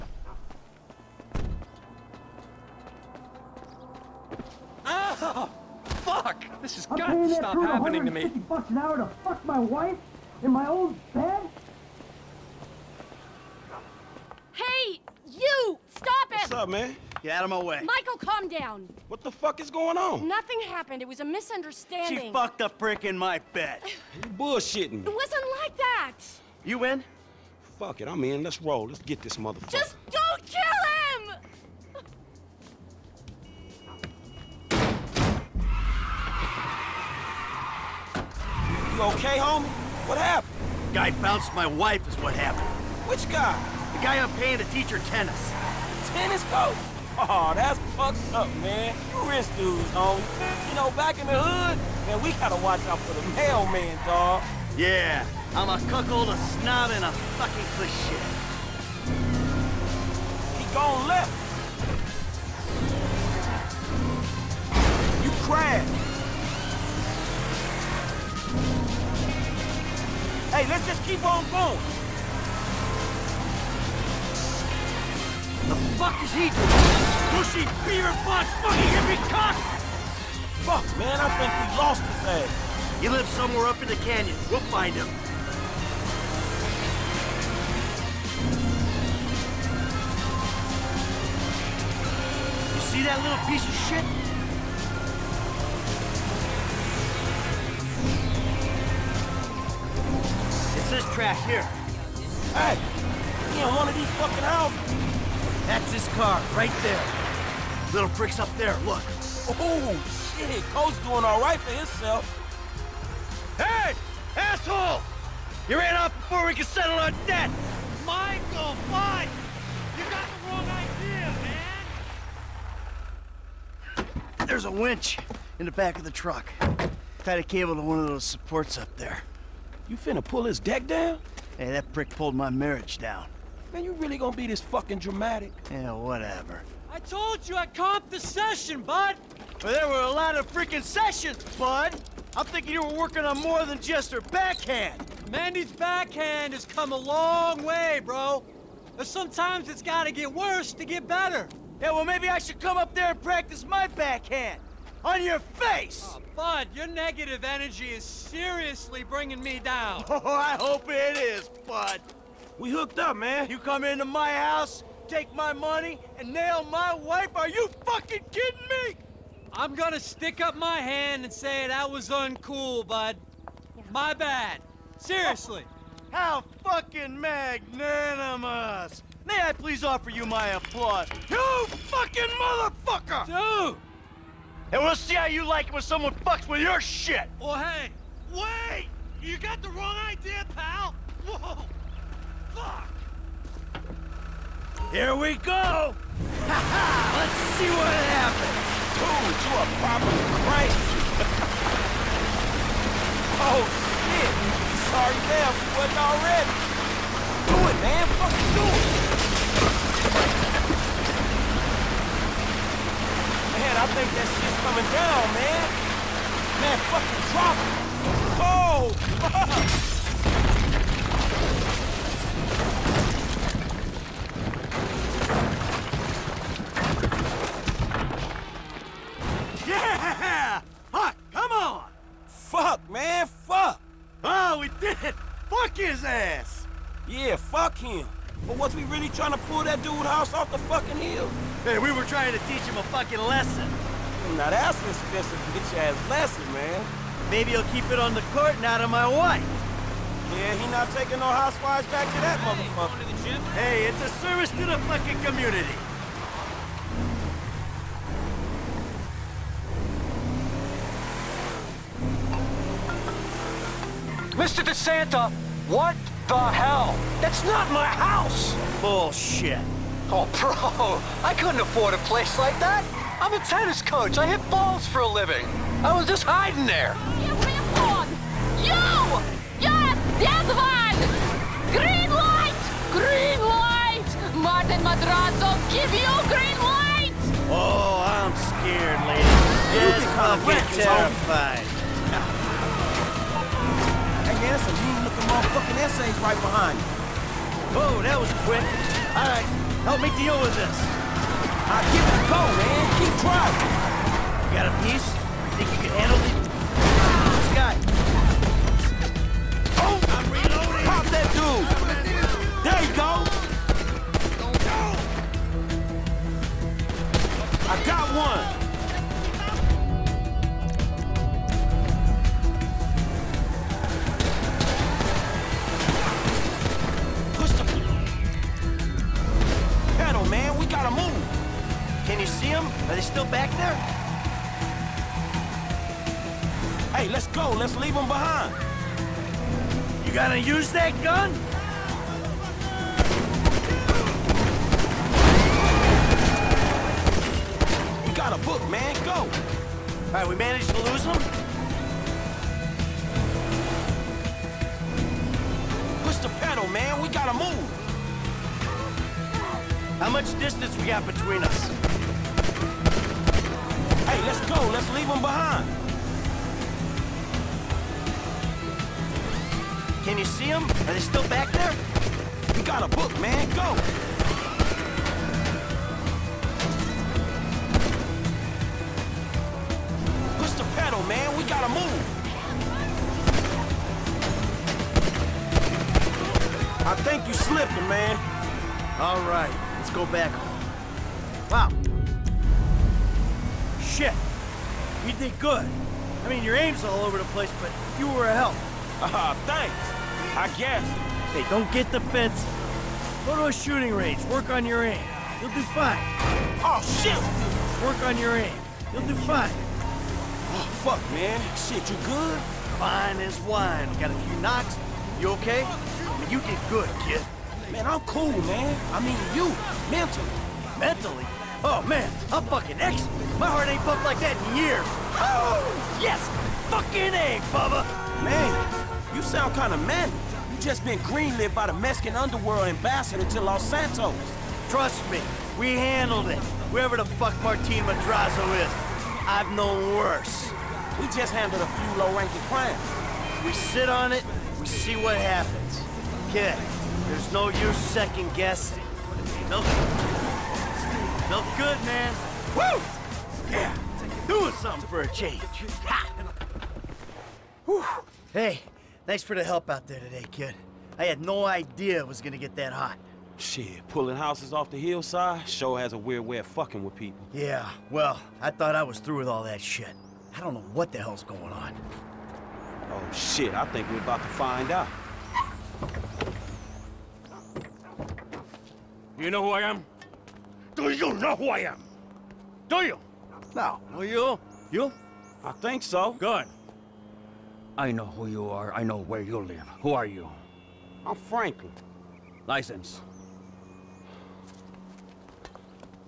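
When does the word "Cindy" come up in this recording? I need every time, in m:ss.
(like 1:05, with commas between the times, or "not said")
not said.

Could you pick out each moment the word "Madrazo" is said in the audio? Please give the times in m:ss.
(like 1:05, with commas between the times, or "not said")
4:44, 7:17.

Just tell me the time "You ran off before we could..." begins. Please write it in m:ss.
1:55.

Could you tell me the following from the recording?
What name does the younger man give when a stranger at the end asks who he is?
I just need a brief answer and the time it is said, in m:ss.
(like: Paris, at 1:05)
Franklin, at 8:11.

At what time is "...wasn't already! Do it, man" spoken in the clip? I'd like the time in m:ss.
3:26.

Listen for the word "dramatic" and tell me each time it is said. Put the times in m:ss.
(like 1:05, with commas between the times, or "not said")
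2:14.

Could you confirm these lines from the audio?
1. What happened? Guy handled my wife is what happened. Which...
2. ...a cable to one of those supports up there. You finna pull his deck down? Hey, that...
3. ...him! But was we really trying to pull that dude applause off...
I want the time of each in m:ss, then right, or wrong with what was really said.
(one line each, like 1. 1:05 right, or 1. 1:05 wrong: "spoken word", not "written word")
1. 0:40 wrong: "bounced", not "handled"
2. 2:07 right
3. 3:57 wrong: "house", not "applause".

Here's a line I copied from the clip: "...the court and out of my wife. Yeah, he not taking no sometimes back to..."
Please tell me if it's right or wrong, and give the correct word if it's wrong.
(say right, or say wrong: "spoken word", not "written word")
wrong: "housewives", not "sometimes".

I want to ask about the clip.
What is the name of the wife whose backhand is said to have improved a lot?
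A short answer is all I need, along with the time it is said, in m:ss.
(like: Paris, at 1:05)
Mandy, at 2:25.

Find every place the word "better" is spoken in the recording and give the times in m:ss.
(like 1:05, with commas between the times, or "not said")
2:31.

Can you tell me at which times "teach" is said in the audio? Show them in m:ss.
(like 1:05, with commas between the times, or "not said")
0:44, 4:02.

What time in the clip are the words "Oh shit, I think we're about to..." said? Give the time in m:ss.
7:52.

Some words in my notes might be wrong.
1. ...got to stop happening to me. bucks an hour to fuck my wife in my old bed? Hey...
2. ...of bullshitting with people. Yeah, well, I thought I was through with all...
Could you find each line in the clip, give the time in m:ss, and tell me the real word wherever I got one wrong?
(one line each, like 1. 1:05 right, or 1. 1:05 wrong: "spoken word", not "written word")
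1. 0:06 right
2. 7:46 wrong: "fucking", not "bullshitting".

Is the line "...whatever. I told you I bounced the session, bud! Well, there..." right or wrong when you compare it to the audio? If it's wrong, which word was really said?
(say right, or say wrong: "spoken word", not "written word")
wrong: "comped", not "bounced".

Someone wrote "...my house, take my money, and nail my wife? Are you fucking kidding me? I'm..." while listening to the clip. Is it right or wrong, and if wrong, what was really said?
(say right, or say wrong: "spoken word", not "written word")
right.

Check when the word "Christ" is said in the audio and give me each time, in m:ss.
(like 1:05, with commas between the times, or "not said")
3:20.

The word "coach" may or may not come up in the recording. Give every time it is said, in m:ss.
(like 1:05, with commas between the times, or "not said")
0:46, 4:33.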